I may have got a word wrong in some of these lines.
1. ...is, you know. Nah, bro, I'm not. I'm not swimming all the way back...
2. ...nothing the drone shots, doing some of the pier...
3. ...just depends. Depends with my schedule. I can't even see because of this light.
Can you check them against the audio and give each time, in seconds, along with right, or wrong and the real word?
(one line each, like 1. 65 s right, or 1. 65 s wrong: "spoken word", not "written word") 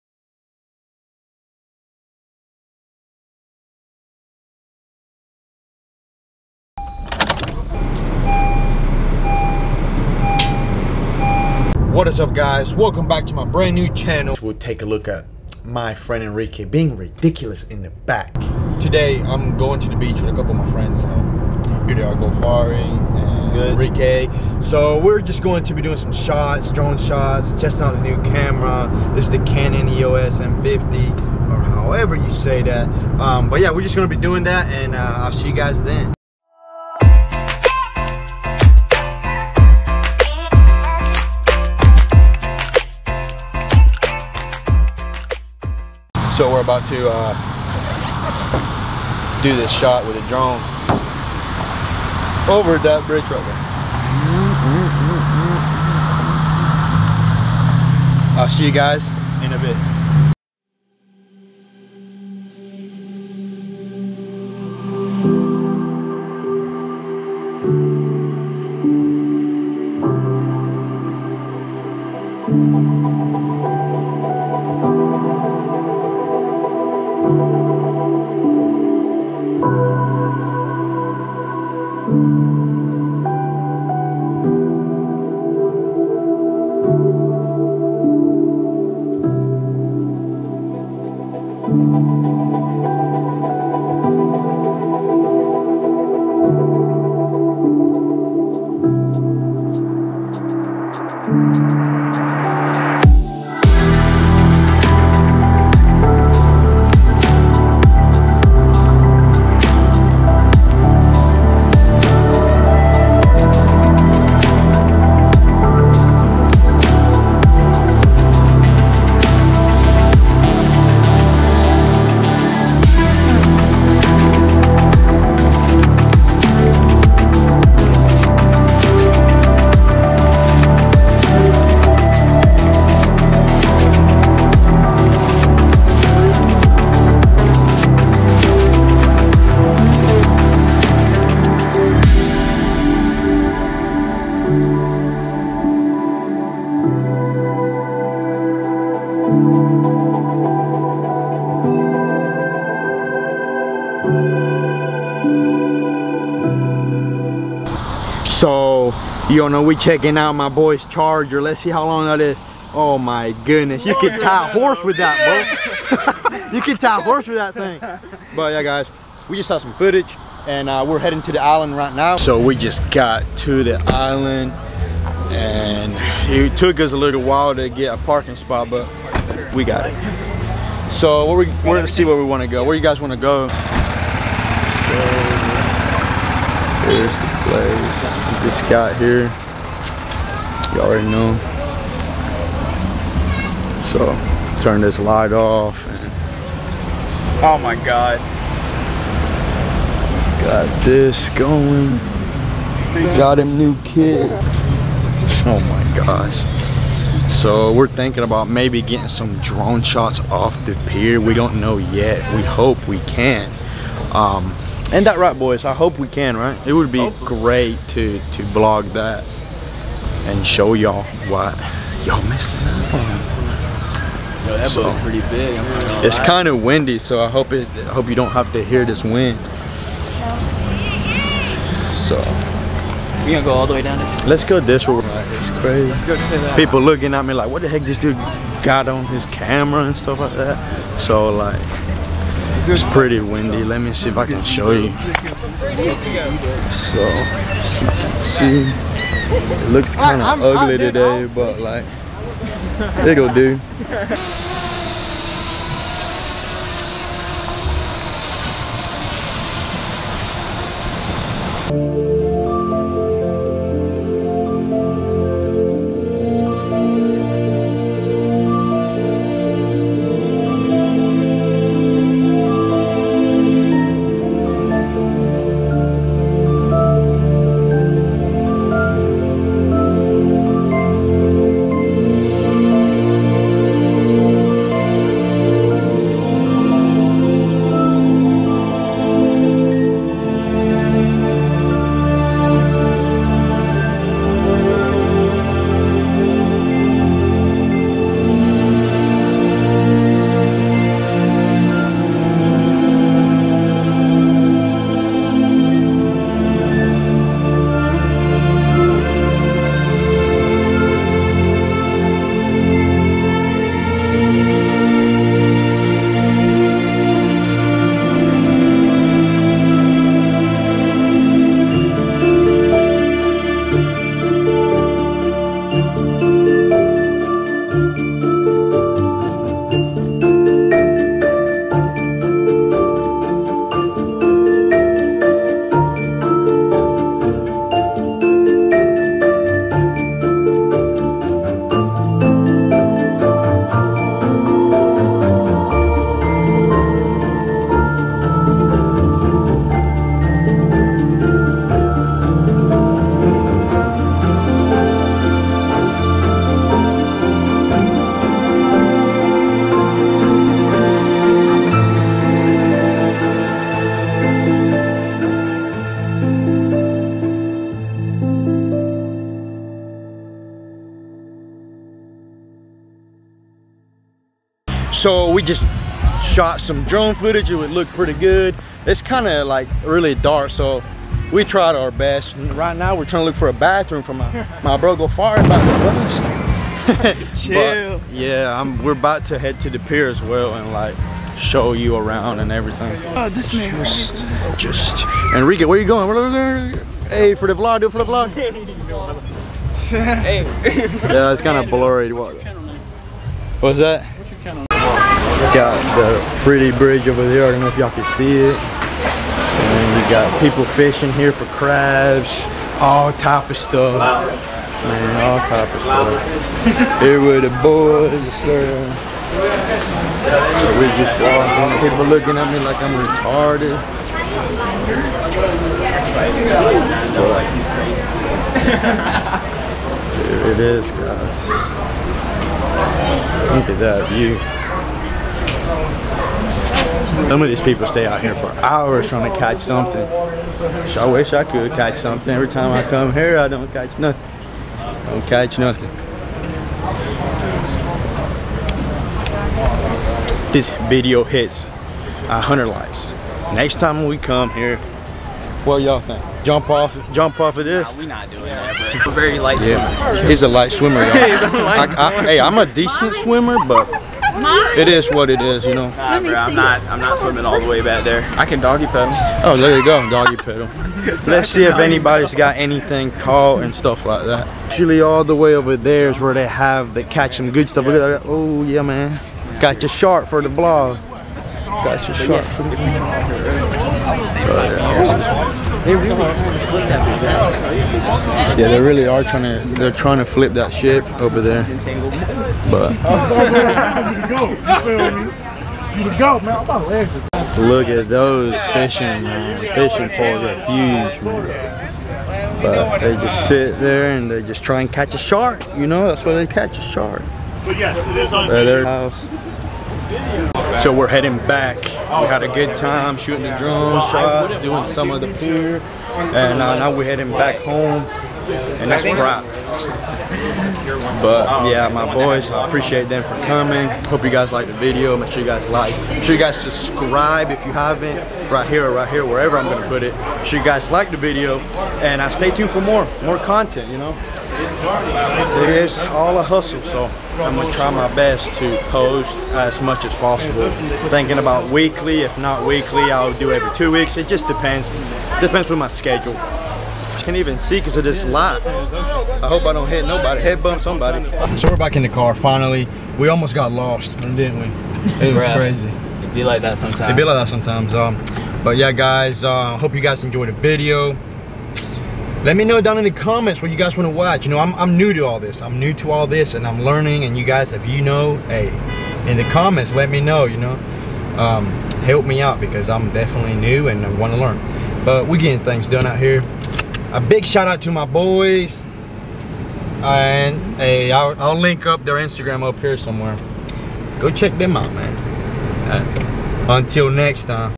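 1. 465 s right
2. 513 s wrong: "shooting", not "nothing"
3. 544 s right.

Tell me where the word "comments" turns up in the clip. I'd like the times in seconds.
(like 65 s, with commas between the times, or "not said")
563 s, 569 s.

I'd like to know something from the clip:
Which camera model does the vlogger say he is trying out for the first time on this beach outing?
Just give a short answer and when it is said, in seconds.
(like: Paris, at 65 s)
Canon EOS M50, at 29 s.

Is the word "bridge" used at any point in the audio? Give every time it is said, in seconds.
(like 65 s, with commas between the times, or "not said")
53 s, 406 s.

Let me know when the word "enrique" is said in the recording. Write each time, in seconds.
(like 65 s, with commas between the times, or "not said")
16 s, 23 s, 395 s.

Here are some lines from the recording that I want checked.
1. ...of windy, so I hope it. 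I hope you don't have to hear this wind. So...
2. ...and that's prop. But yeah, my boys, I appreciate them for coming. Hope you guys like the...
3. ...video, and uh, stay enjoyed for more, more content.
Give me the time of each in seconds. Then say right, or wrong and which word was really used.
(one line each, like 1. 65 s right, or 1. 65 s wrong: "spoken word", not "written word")
1. 226 s right
2. 518 s right
3. 531 s wrong: "tuned", not "enjoyed".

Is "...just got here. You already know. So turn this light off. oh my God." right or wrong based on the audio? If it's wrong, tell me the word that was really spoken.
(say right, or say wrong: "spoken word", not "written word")
right.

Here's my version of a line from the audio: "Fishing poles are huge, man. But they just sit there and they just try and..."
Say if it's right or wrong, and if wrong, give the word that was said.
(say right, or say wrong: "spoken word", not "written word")
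right.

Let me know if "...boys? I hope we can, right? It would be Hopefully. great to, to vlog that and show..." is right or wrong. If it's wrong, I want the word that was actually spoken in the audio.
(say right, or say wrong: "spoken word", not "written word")
right.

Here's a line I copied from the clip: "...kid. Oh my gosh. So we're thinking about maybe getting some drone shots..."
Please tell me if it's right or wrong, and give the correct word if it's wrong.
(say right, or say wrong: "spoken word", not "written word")
right.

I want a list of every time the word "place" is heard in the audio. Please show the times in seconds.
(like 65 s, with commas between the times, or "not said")
187 s.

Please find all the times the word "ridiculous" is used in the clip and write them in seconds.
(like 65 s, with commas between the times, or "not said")
16 s.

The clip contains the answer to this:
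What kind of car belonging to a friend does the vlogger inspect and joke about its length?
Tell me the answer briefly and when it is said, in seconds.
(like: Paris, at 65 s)
Charger, at 160 s.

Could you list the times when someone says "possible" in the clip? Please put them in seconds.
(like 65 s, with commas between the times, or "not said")
540 s.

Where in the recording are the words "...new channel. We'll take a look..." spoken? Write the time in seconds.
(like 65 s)
13 s.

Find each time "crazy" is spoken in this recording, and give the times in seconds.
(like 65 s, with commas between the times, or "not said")
235 s, 555 s.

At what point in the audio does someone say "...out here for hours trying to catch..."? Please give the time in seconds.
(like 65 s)
438 s.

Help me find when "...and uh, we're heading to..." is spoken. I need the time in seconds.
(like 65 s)
170 s.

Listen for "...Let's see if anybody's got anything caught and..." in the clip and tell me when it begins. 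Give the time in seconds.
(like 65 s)
471 s.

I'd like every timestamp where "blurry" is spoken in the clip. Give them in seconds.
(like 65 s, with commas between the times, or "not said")
401 s.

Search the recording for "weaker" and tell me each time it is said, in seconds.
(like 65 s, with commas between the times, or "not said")
not said.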